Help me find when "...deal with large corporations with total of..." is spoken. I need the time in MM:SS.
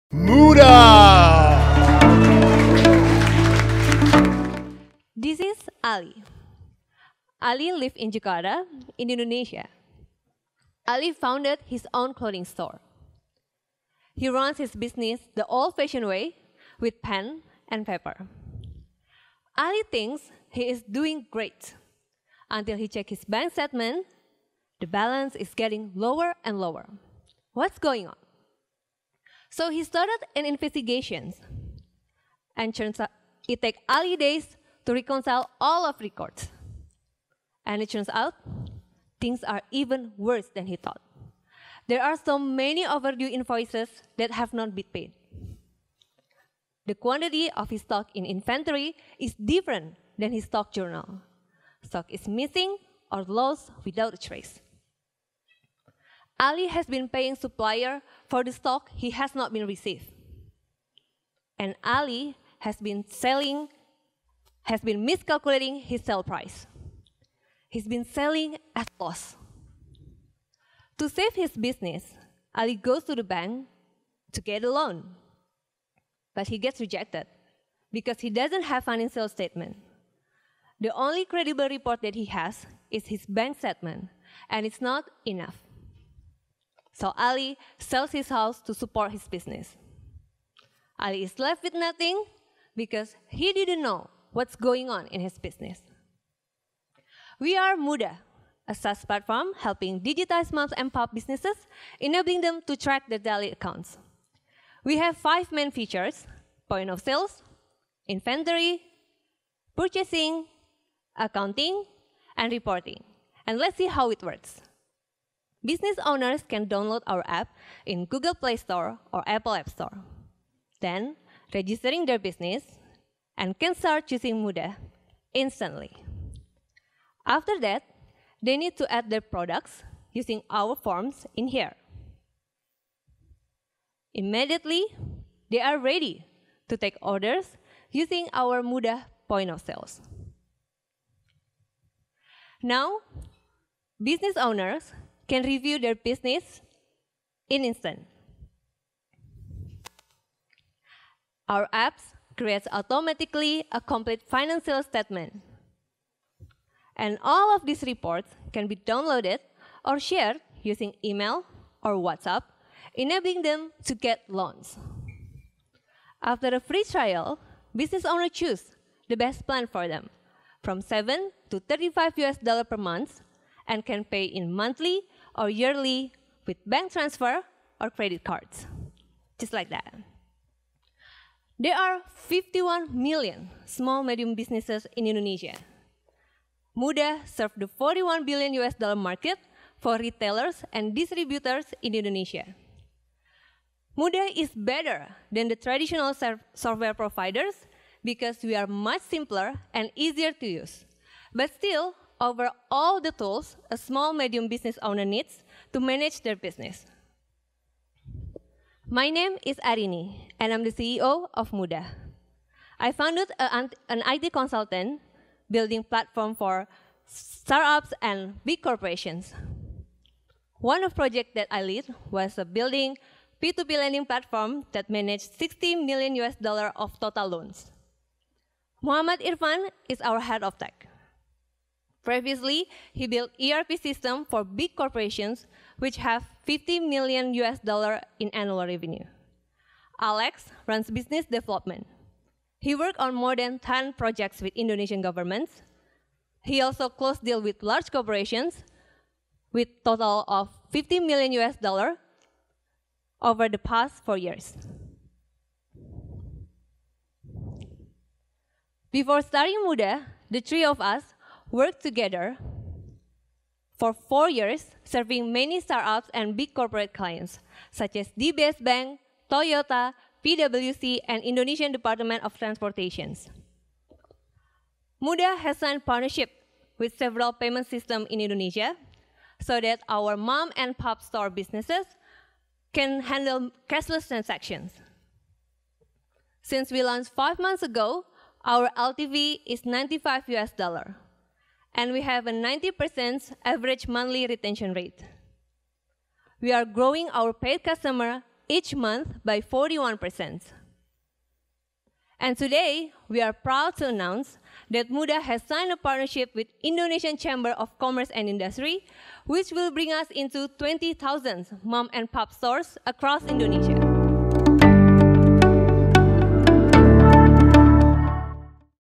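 04:07.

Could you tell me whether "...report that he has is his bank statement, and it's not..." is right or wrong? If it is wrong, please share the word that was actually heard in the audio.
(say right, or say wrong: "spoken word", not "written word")
right.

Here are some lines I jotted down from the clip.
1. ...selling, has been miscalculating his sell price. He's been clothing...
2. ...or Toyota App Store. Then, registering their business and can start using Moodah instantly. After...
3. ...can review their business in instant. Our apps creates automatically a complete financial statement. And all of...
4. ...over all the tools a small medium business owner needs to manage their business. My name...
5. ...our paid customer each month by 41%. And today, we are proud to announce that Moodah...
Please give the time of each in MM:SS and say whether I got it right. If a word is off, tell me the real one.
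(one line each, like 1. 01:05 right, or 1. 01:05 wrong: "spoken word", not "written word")
1. 01:03 wrong: "selling", not "clothing"
2. 01:59 wrong: "Apple", not "Toyota"
3. 02:25 right
4. 03:22 right
5. 04:57 right.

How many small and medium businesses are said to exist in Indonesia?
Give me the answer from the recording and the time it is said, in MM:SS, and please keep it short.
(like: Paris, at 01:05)
51 million, at 03:02.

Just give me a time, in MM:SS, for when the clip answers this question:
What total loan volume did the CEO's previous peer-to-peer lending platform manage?
03:45.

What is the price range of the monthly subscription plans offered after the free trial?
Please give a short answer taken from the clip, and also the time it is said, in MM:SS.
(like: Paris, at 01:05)
$7 to $35, at 02:50.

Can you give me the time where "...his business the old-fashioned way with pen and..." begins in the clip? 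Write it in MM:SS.
00:14.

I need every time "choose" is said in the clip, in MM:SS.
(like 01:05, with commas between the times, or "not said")
02:48.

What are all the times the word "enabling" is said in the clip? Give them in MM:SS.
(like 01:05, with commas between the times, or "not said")
01:41, 02:42.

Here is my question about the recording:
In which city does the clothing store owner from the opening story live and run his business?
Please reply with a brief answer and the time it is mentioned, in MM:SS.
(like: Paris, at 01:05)
Jakarta, at 00:08.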